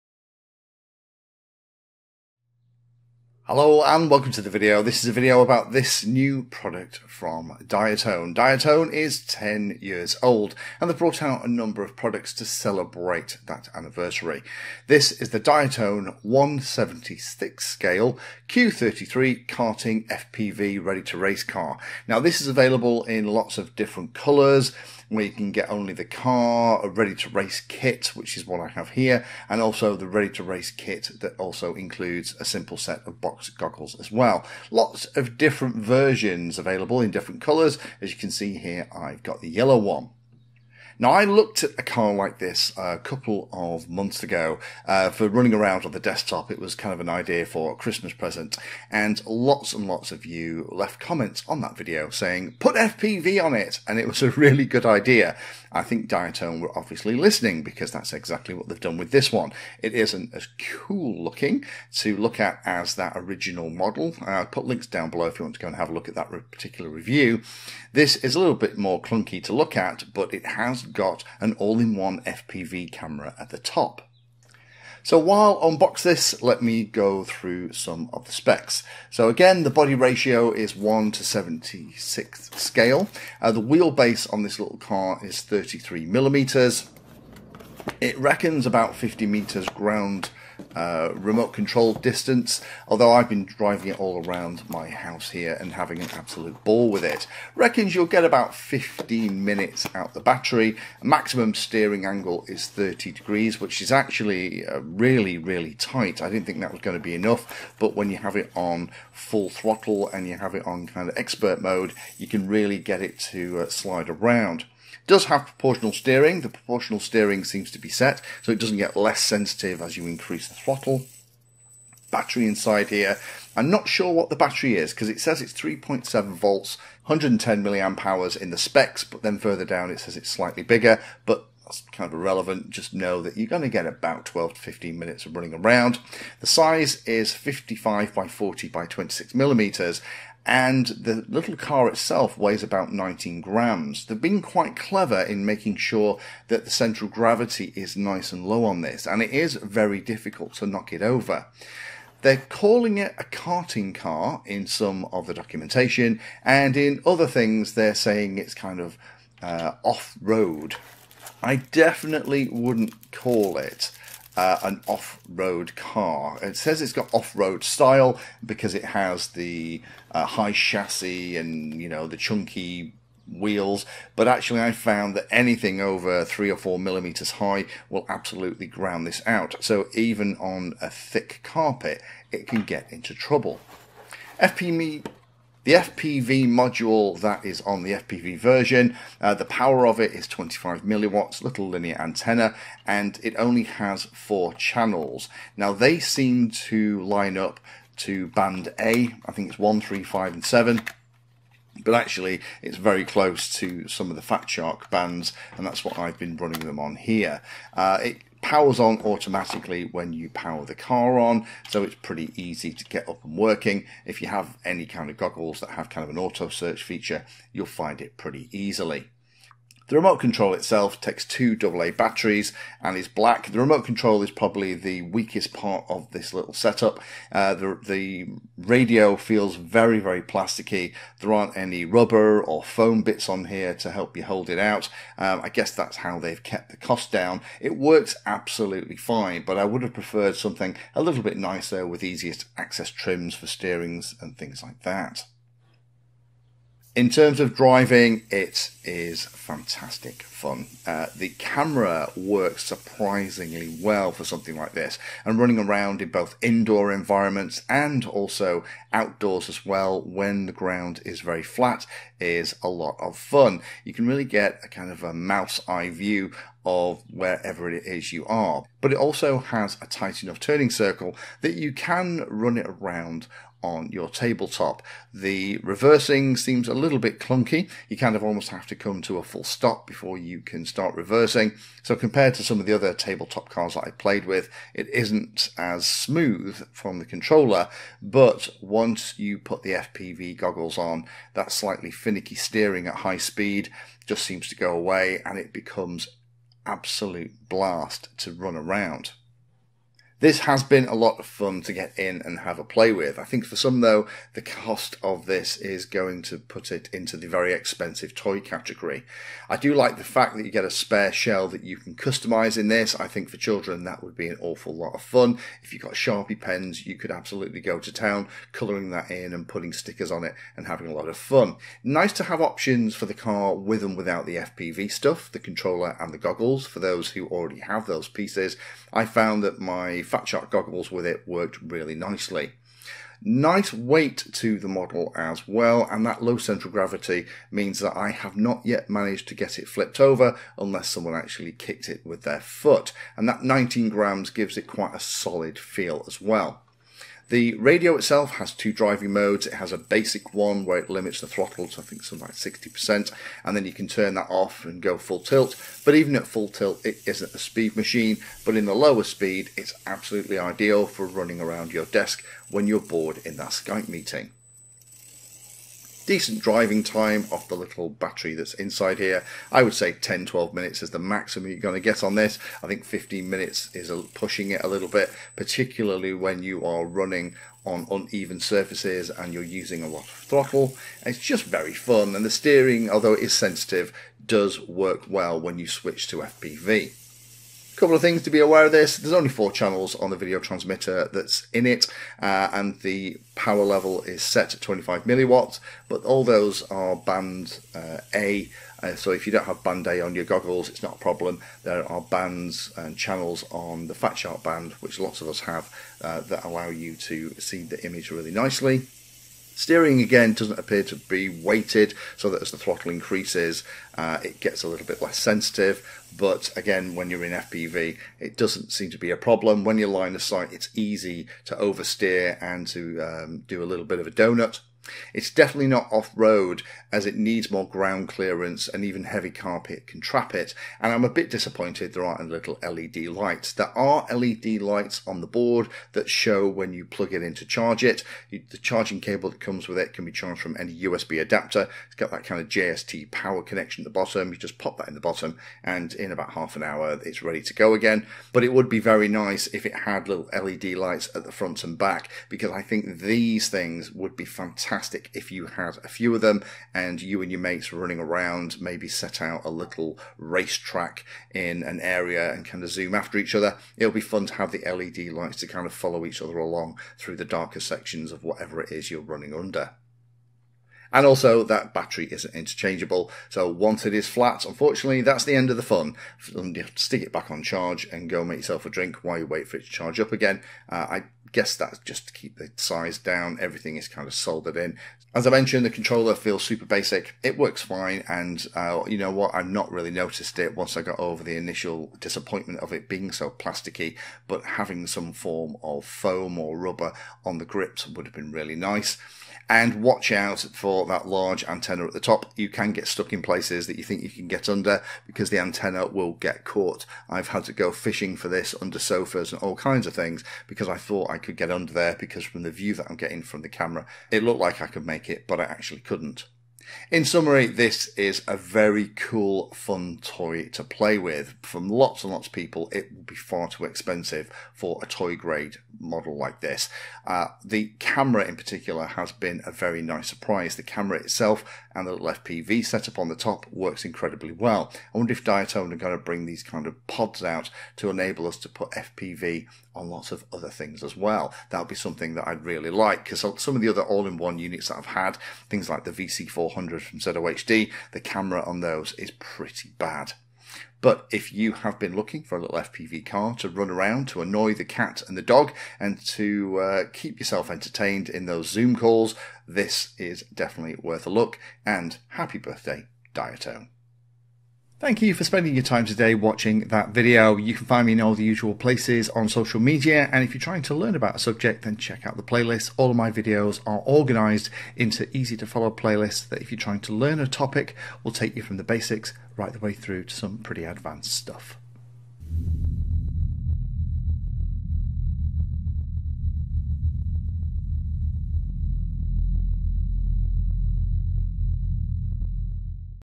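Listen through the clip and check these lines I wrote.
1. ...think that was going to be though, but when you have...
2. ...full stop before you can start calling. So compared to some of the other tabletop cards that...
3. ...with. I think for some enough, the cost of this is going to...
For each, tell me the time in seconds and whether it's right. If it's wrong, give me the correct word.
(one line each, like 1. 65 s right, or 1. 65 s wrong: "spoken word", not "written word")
1. 106 s wrong: "enough", not "though"
2. 279 s wrong: "reversing", not "calling"
3. 302 s wrong: "though", not "enough".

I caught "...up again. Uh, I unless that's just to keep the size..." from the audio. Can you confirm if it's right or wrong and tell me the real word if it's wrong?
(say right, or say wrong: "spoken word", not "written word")
wrong: "guess", not "unless".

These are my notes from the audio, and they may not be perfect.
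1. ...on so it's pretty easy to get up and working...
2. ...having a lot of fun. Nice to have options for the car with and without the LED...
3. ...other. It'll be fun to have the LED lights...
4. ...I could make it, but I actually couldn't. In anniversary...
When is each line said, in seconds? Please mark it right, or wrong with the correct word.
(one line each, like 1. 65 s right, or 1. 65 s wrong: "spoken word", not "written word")
1. 211 s right
2. 320 s wrong: "FPV", not "LED"
3. 463 s right
4. 514 s wrong: "summary", not "anniversary".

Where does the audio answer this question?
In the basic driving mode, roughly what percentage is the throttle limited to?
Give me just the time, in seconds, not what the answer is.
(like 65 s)
352 s.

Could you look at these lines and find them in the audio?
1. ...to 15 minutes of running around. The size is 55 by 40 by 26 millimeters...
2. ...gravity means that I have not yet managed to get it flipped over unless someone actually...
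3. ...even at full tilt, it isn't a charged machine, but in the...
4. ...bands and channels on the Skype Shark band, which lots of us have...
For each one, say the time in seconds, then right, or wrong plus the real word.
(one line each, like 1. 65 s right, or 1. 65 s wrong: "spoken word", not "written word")
1. 134 s right
2. 336 s right
3. 355 s wrong: "speed", not "charged"
4. 402 s wrong: "Fat", not "Skype".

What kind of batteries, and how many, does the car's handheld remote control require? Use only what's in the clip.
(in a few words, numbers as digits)
2 AA.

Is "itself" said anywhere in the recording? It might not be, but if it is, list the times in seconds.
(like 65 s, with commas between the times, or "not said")
141 s, 220 s, 347 s, 530 s.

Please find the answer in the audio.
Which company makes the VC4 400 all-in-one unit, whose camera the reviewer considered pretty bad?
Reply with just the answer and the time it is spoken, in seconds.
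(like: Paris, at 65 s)
ZOHD, at 546 s.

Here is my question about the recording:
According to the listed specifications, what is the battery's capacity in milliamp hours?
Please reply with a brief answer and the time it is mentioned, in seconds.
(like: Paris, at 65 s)
110, at 127 s.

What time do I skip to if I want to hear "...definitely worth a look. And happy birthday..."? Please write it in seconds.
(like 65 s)
560 s.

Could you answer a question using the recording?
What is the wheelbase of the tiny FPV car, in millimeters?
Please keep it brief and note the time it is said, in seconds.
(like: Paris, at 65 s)
33 millimeters, at 85 s.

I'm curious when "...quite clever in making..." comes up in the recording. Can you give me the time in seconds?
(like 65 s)
144 s.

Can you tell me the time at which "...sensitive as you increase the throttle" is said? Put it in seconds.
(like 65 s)
119 s.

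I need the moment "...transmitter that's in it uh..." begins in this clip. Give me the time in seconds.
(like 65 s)
390 s.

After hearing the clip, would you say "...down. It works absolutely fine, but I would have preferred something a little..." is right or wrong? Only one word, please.
right.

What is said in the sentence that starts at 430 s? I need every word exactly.
And I'm a bit disappointed there aren't little LED lights.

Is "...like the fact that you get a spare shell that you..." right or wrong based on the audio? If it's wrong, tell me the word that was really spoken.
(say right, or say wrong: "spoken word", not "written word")
right.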